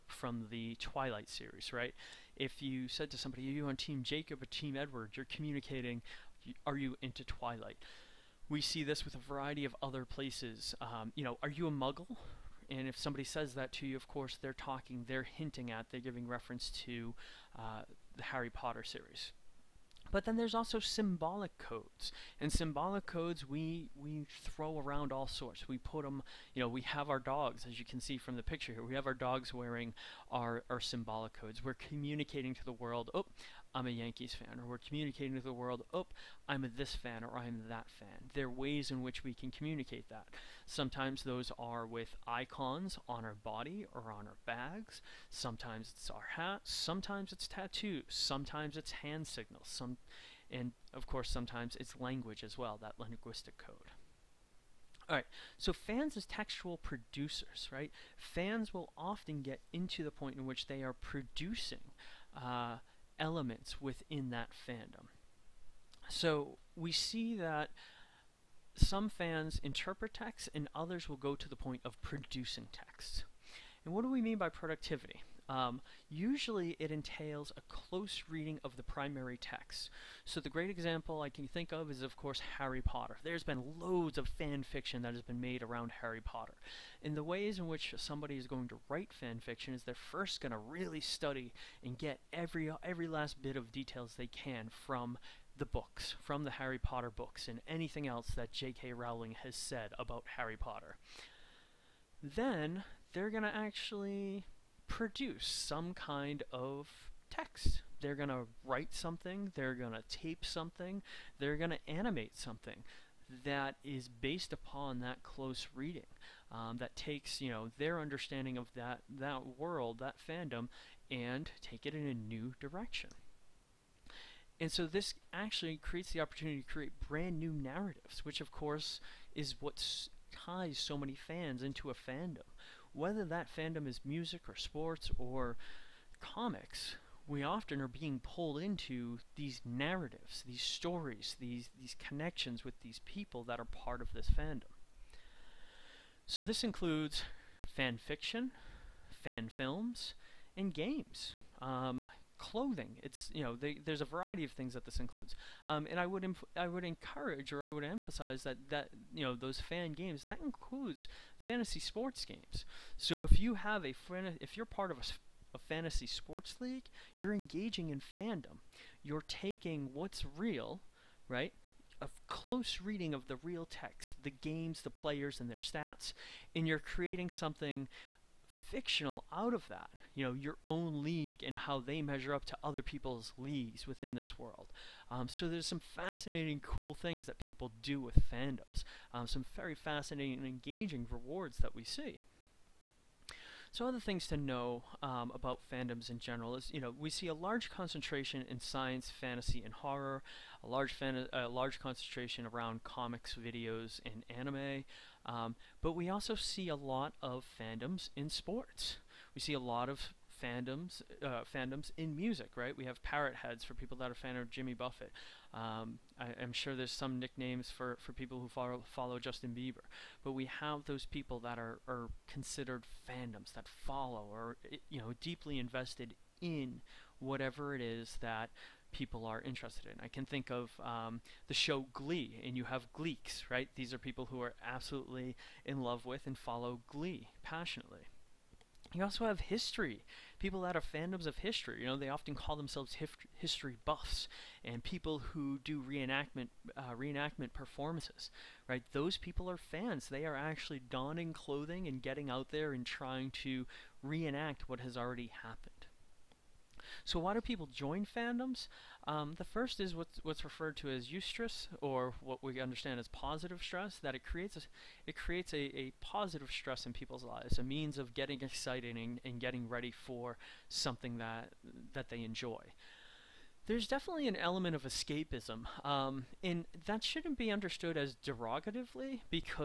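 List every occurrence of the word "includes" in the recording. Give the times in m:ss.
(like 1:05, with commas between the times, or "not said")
2:26, 2:34, 2:40.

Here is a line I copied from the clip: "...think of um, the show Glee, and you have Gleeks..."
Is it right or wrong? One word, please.
right.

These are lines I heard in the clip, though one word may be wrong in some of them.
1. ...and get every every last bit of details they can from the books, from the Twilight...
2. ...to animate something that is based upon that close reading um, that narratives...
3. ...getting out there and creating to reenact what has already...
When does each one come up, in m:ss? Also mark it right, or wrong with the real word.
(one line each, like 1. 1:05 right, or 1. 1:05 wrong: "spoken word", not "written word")
1. 1:31 wrong: "Harry", not "Twilight"
2. 1:51 wrong: "takes", not "narratives"
3. 4:11 wrong: "trying", not "creating".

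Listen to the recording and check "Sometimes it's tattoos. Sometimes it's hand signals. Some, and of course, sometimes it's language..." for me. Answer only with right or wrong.
right.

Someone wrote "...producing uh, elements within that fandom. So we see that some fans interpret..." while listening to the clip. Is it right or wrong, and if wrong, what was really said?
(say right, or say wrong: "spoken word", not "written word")
right.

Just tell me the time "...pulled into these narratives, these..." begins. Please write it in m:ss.
2:18.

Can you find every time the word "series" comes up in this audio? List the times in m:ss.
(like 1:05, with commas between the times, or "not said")
0:01, 0:18.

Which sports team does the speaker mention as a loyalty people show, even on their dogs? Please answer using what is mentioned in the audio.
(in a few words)
Yankees.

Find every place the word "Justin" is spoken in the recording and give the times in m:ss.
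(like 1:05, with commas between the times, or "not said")
3:39.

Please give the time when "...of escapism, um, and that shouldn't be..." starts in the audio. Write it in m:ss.
4:34.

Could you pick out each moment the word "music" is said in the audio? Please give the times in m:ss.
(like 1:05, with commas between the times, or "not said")
2:14, 3:32.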